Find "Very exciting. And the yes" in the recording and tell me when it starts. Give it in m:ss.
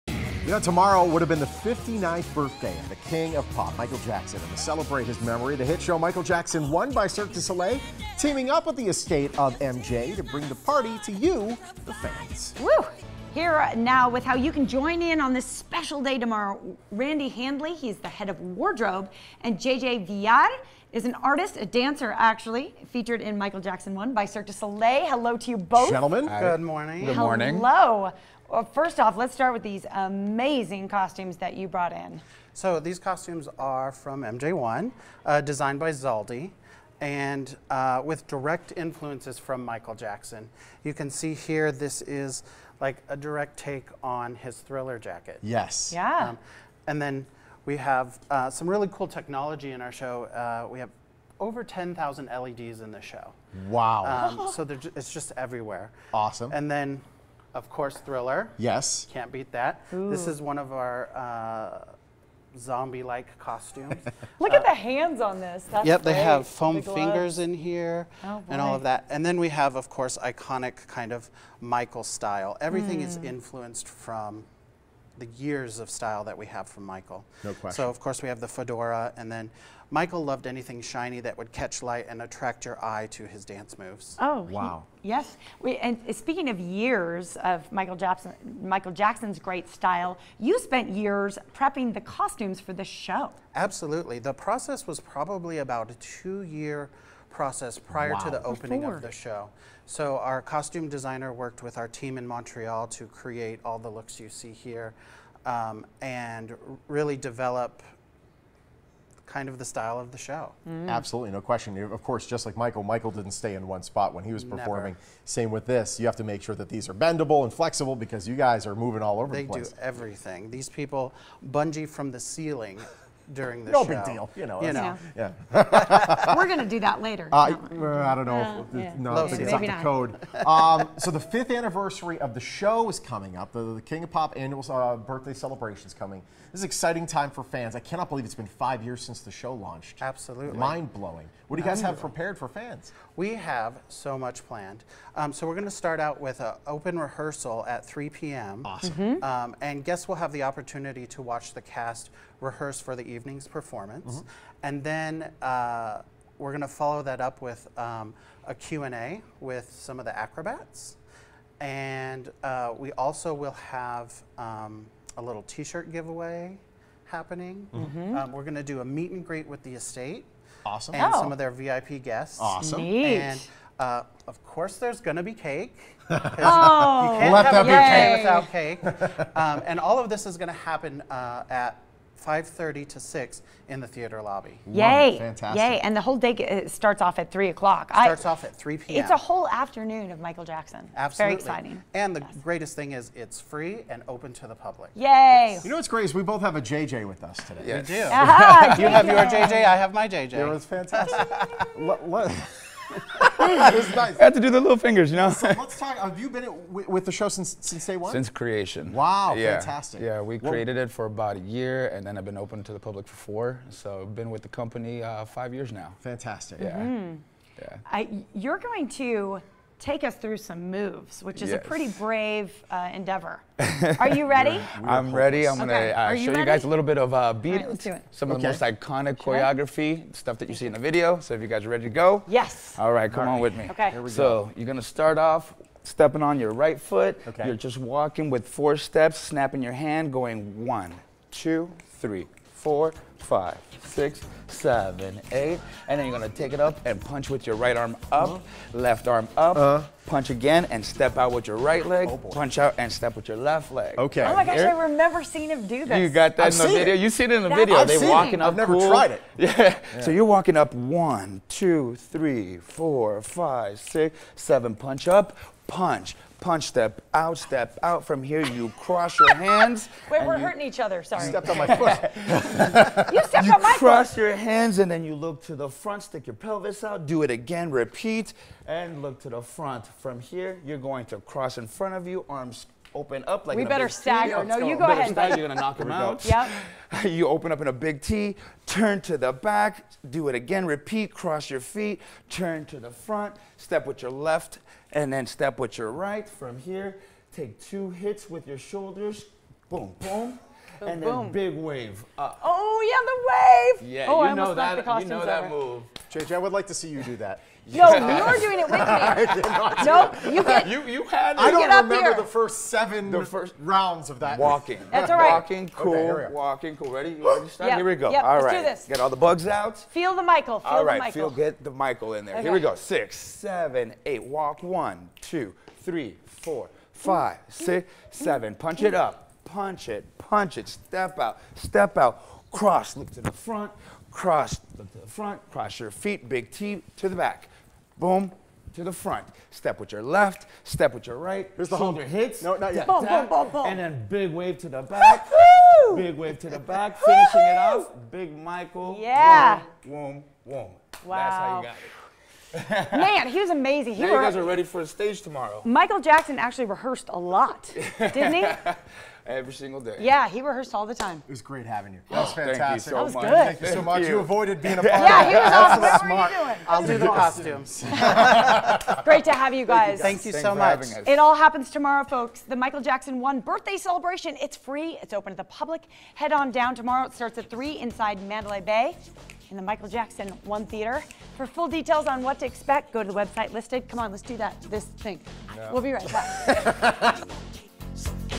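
3:11.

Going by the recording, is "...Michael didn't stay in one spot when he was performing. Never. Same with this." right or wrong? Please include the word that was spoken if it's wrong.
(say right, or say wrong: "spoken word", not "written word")
right.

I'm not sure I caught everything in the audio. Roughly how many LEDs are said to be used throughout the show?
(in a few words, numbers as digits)
10,000.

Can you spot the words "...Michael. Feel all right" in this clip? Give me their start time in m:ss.
5:20.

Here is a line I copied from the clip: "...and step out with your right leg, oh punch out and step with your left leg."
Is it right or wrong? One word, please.
right.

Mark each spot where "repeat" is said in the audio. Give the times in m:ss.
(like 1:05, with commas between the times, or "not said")
4:37, 4:50.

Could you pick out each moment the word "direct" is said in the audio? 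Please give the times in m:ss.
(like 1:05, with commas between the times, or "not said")
0:38, 0:43.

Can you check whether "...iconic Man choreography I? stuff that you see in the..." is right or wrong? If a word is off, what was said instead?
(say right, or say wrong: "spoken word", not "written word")
wrong: "Should", not "Man".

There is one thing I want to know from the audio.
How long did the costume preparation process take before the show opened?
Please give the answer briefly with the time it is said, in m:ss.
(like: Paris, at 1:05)
2 years, at 1:35.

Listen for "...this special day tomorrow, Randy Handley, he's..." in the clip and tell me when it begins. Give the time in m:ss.
0:15.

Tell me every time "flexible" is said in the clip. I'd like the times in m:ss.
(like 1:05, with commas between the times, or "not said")
1:57.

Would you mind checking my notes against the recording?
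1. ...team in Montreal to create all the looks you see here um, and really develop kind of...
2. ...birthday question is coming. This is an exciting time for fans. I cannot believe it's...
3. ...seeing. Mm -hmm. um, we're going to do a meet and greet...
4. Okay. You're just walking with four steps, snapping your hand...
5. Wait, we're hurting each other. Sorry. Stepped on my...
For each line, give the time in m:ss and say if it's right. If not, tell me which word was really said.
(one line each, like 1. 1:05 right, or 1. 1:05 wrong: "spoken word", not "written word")
1. 1:41 right
2. 2:14 wrong: "celebration", not "question"
3. 2:47 wrong: "happening", not "seeing"
4. 3:57 right
5. 4:30 right.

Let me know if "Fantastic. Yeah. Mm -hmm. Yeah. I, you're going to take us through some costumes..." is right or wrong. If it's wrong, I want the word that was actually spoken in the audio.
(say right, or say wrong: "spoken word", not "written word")
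wrong: "moves", not "costumes".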